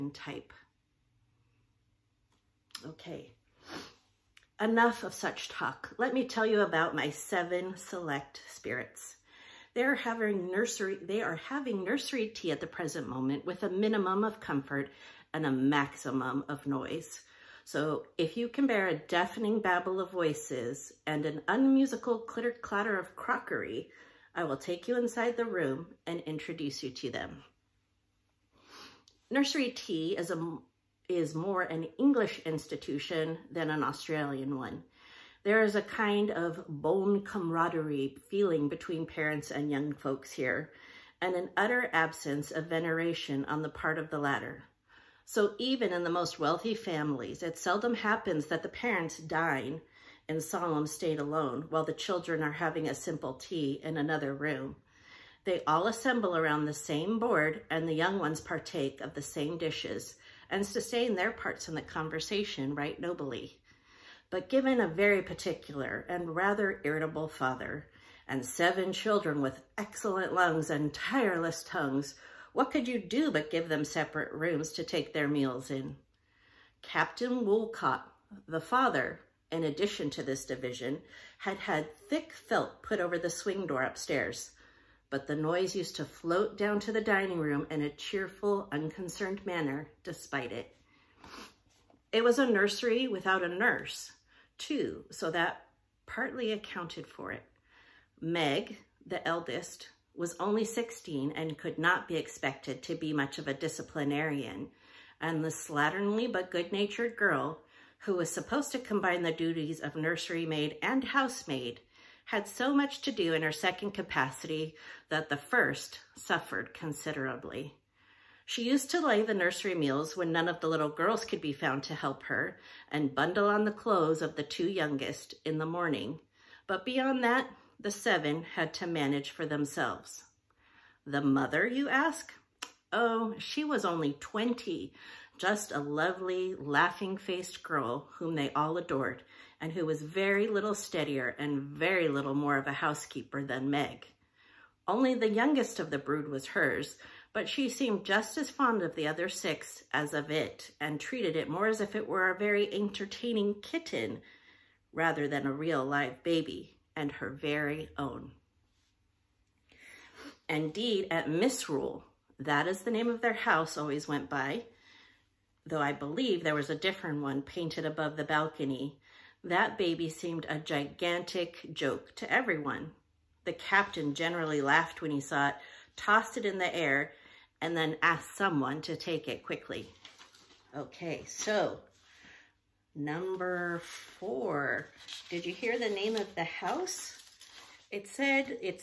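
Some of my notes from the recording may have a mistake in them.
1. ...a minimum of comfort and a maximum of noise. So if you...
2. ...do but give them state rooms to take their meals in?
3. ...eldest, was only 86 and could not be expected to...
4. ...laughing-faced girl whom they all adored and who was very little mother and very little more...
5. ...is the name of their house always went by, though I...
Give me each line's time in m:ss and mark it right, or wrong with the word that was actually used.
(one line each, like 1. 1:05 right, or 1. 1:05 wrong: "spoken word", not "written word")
1. 0:13 right
2. 1:12 wrong: "separate", not "state"
3. 1:39 wrong: "16", not "86"
4. 2:16 wrong: "steadier", not "mother"
5. 2:42 right.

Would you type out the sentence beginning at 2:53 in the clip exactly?
The captain generally laughed when he saw it, tossed it in the air, and then asked someone to take it quickly.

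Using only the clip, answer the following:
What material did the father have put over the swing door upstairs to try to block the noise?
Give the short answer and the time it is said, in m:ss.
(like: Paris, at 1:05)
Thick felt, at 1:22.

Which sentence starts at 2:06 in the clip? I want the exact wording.
But beyond that, the seven had to manage for themselves.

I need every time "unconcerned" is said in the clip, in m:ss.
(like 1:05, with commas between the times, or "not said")
1:28.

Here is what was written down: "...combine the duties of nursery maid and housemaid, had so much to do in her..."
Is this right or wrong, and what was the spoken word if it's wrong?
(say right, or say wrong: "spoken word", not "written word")
right.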